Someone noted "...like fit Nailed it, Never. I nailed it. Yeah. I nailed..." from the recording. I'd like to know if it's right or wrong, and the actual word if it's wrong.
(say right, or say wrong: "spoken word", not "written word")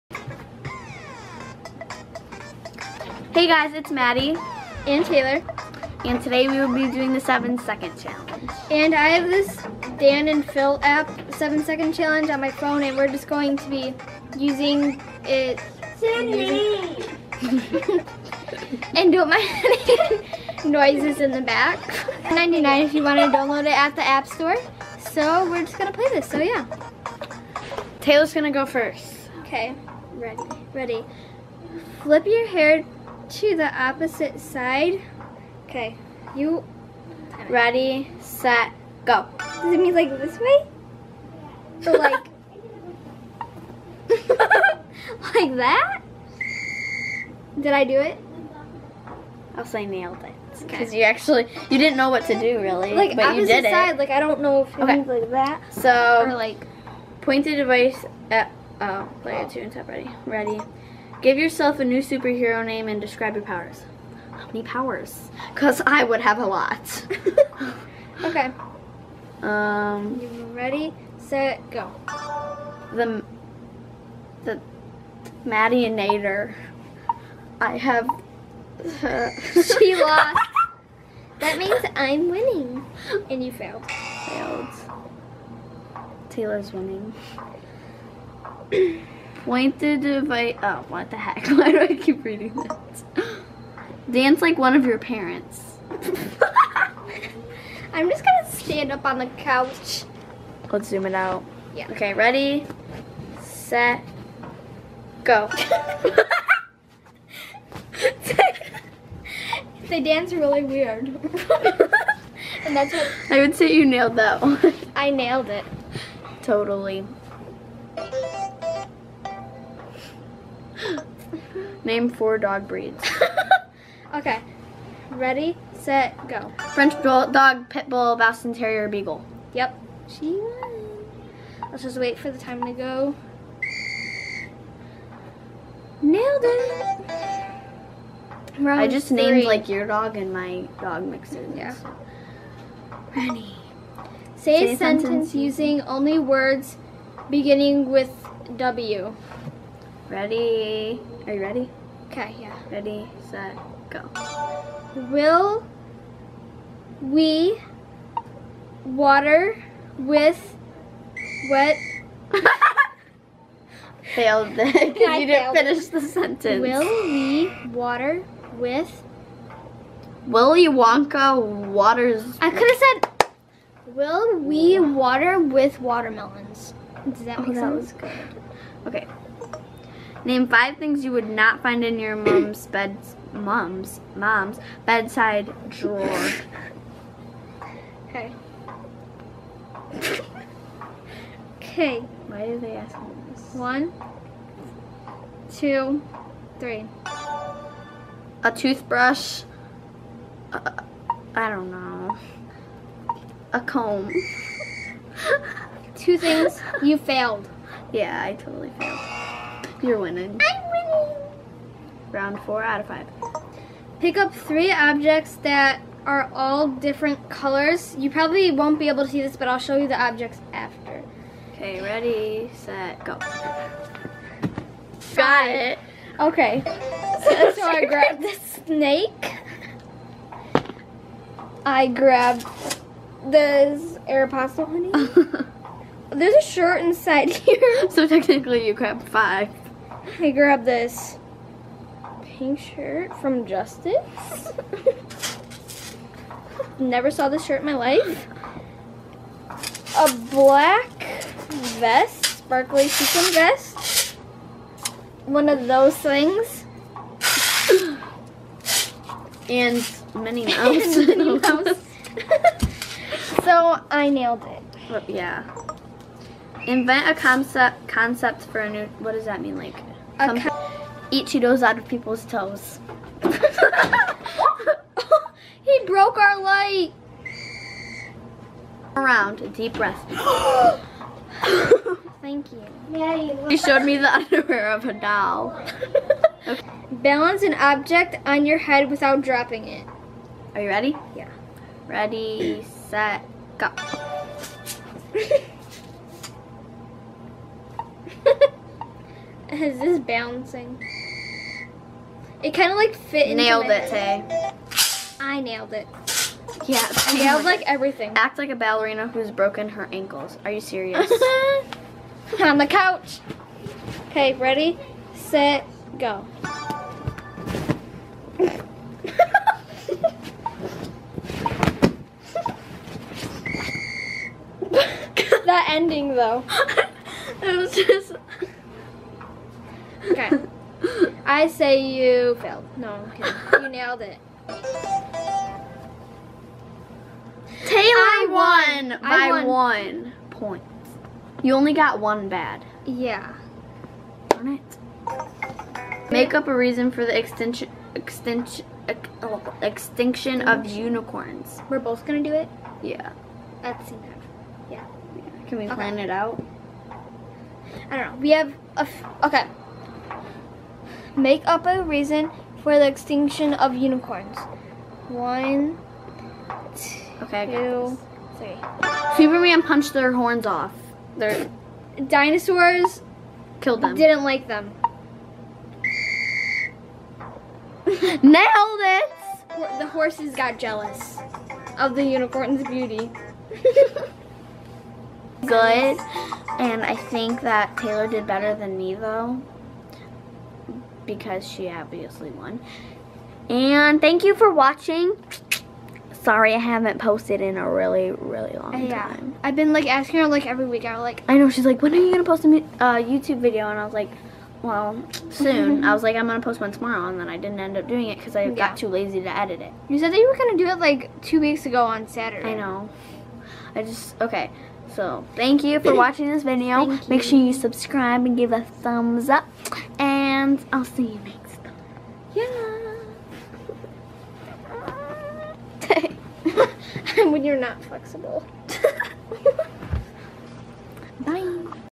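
wrong: "Tay", not "Never".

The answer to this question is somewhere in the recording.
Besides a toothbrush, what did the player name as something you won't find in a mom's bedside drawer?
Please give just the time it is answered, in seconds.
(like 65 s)
203 s.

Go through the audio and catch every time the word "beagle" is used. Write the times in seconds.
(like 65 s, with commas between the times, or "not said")
128 s.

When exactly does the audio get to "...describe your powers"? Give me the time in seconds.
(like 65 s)
62 s.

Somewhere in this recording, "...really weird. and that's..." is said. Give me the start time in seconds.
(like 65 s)
110 s.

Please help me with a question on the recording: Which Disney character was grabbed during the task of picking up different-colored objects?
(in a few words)
Minnie Mouse.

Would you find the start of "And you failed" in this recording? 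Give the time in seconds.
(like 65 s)
83 s.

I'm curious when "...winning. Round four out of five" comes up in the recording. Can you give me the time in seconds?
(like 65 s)
210 s.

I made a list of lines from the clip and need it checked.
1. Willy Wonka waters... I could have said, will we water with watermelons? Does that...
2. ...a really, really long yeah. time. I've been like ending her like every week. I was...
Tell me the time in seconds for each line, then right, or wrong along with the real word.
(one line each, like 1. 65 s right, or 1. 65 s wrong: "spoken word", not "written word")
1. 170 s right
2. 397 s wrong: "asking", not "ending".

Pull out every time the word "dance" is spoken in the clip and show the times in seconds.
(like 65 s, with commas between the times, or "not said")
94 s, 110 s.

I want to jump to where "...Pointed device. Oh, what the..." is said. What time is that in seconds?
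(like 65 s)
89 s.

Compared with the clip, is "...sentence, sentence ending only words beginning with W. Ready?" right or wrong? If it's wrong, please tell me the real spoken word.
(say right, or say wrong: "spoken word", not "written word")
wrong: "using", not "ending".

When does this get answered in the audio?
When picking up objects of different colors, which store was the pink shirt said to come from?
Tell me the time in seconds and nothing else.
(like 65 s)
243 s.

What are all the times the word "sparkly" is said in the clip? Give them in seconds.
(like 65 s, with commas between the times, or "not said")
252 s.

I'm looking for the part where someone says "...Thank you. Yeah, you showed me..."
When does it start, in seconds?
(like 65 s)
282 s.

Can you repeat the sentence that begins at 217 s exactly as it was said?
You probably won't be able to see this, but I'll show you the objects after.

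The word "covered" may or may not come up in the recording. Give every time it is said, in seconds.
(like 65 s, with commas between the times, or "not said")
not said.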